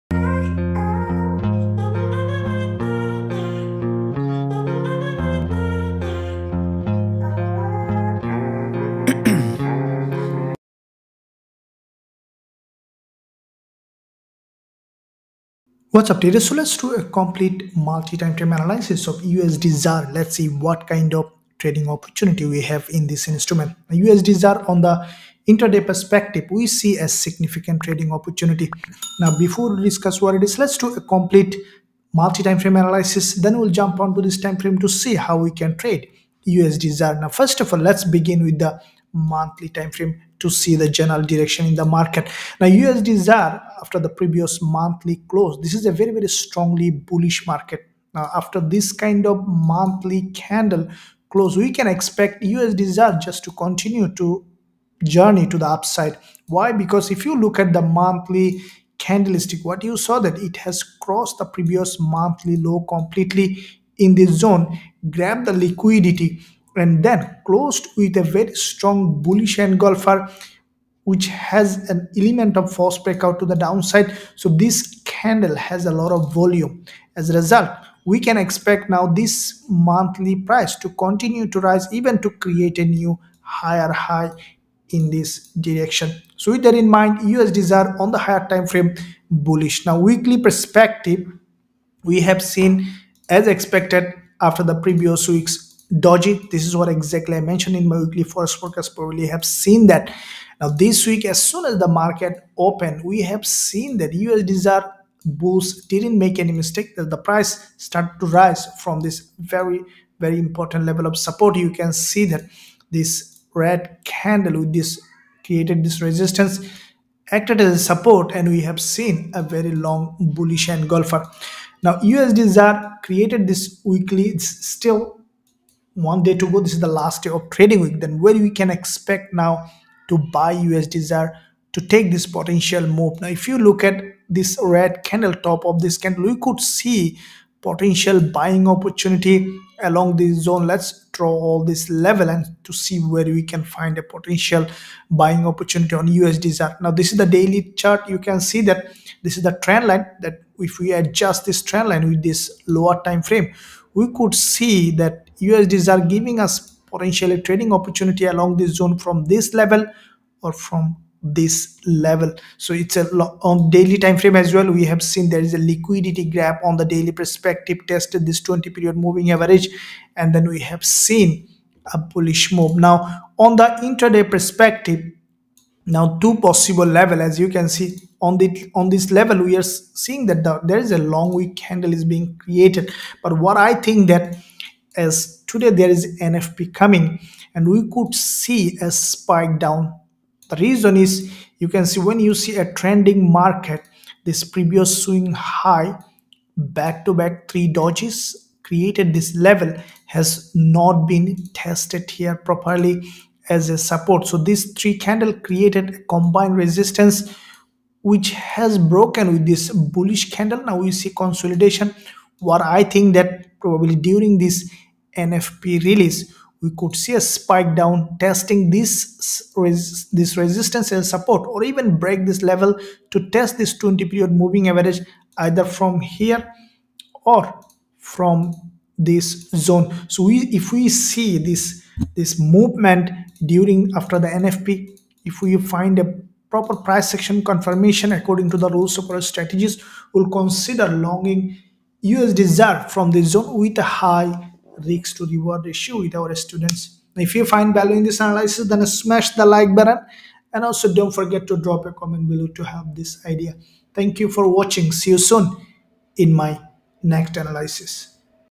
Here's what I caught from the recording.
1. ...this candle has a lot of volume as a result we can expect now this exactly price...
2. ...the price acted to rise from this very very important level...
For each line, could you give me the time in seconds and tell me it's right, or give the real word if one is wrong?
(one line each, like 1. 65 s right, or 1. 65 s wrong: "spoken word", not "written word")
1. 74 s wrong: "monthly", not "exactly"
2. 107 s wrong: "started", not "acted".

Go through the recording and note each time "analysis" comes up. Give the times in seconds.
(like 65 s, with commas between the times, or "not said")
18 s, 32 s, 248 s, 257 s.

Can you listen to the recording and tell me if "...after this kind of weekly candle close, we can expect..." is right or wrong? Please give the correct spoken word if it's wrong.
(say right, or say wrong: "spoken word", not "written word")
wrong: "monthly", not "weekly".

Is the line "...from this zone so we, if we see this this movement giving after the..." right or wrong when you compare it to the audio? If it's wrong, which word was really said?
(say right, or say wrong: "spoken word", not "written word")
wrong: "during", not "giving".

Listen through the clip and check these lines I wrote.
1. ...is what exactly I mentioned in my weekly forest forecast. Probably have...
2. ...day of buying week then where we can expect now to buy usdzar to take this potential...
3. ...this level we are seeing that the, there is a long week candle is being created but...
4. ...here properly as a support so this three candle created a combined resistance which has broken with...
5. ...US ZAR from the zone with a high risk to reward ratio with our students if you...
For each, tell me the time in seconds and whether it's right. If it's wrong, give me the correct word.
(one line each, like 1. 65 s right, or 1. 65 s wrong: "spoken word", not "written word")
1. 96 s right
2. 127 s wrong: "trading", not "buying"
3. 178 s right
4. 202 s right
5. 242 s right.